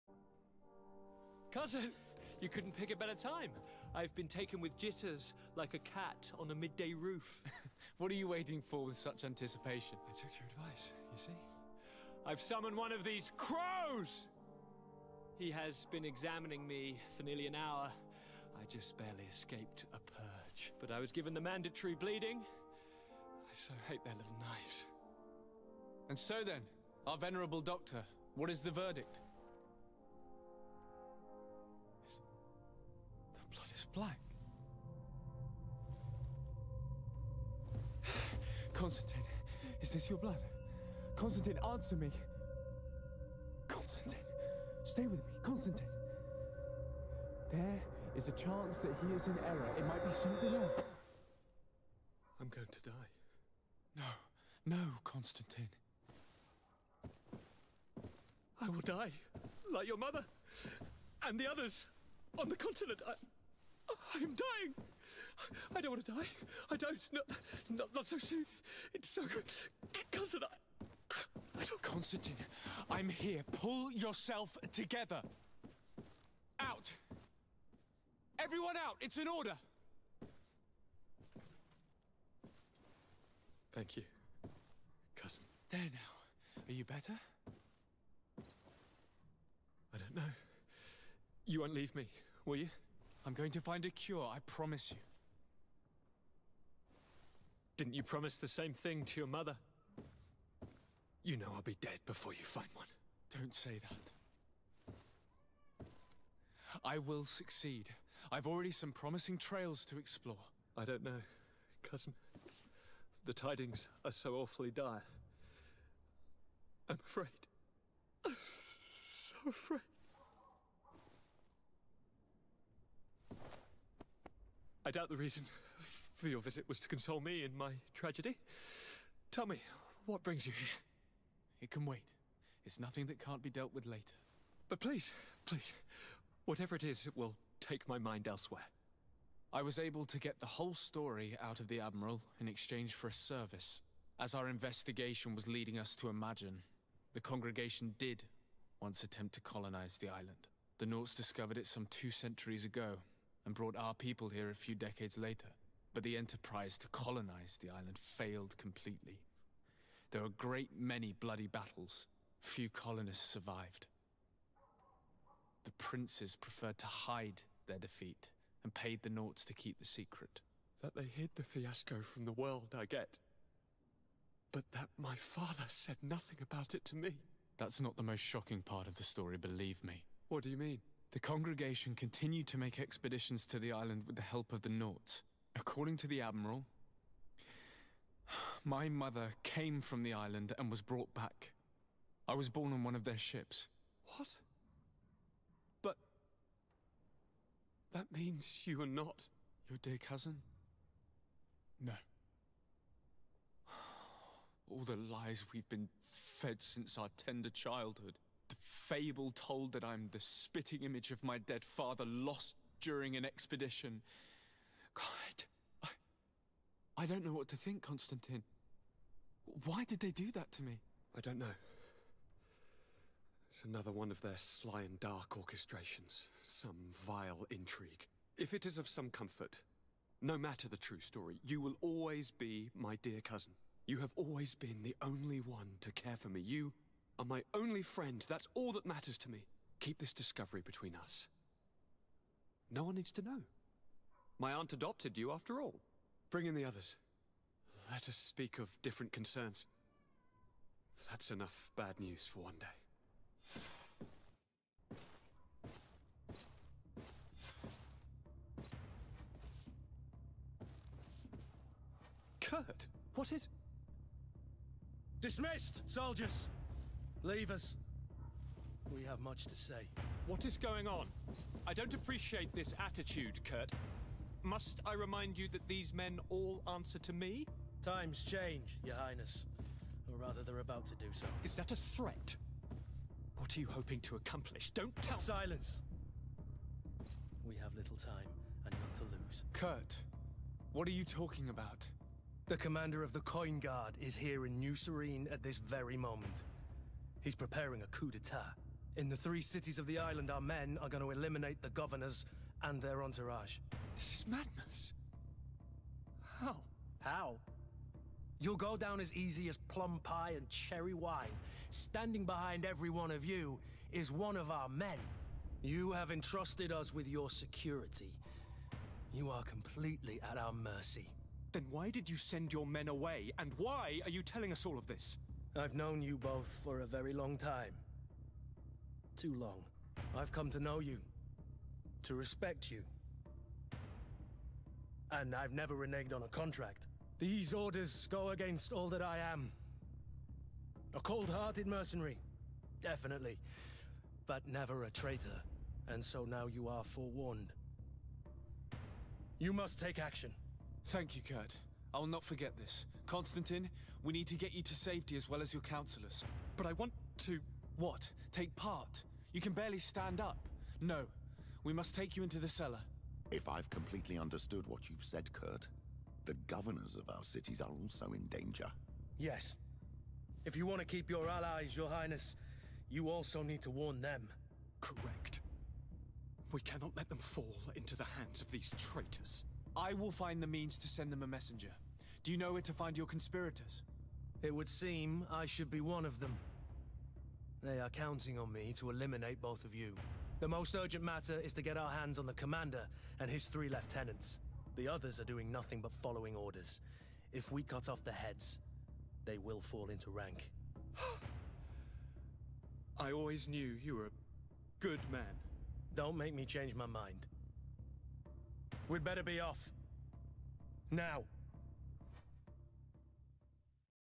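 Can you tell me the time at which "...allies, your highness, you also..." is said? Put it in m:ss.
6:11.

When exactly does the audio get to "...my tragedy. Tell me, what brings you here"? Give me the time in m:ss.
2:07.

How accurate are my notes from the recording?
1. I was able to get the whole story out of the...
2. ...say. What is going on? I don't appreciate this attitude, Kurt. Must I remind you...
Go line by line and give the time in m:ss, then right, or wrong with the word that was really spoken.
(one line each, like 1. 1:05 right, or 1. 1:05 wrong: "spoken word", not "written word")
1. 2:19 right
2. 4:29 right.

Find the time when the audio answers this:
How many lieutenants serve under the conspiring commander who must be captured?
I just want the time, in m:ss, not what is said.
6:33.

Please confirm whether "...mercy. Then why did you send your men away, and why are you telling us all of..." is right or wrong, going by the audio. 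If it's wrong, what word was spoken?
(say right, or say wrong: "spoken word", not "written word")
right.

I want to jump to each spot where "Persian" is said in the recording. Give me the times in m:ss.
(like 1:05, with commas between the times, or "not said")
not said.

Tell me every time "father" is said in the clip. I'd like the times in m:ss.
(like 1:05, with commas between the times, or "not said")
2:55, 3:31.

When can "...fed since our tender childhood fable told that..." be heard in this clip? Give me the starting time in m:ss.
3:26.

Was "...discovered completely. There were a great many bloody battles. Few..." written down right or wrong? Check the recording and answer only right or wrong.
wrong.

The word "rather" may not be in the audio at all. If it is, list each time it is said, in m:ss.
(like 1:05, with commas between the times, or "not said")
4:40.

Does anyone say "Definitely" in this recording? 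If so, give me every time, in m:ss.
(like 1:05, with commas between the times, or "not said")
5:42.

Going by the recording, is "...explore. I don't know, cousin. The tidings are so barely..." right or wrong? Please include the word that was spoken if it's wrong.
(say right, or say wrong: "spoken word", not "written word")
wrong: "awfully", not "barely".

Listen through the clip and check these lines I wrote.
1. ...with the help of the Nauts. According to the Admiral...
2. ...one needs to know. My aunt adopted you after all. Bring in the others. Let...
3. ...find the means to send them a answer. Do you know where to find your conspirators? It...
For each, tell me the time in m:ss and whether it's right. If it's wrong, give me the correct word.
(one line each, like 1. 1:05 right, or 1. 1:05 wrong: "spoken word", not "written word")
1. 3:04 right
2. 4:02 right
3. 6:20 wrong: "messenger", not "answer".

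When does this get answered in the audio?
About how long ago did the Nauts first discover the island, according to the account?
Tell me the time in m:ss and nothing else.
2:31.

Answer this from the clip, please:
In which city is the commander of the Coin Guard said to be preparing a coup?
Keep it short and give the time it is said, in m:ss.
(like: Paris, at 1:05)
New Serene, at 4:54.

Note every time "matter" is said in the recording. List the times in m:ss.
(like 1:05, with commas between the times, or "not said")
3:50, 3:58, 6:31.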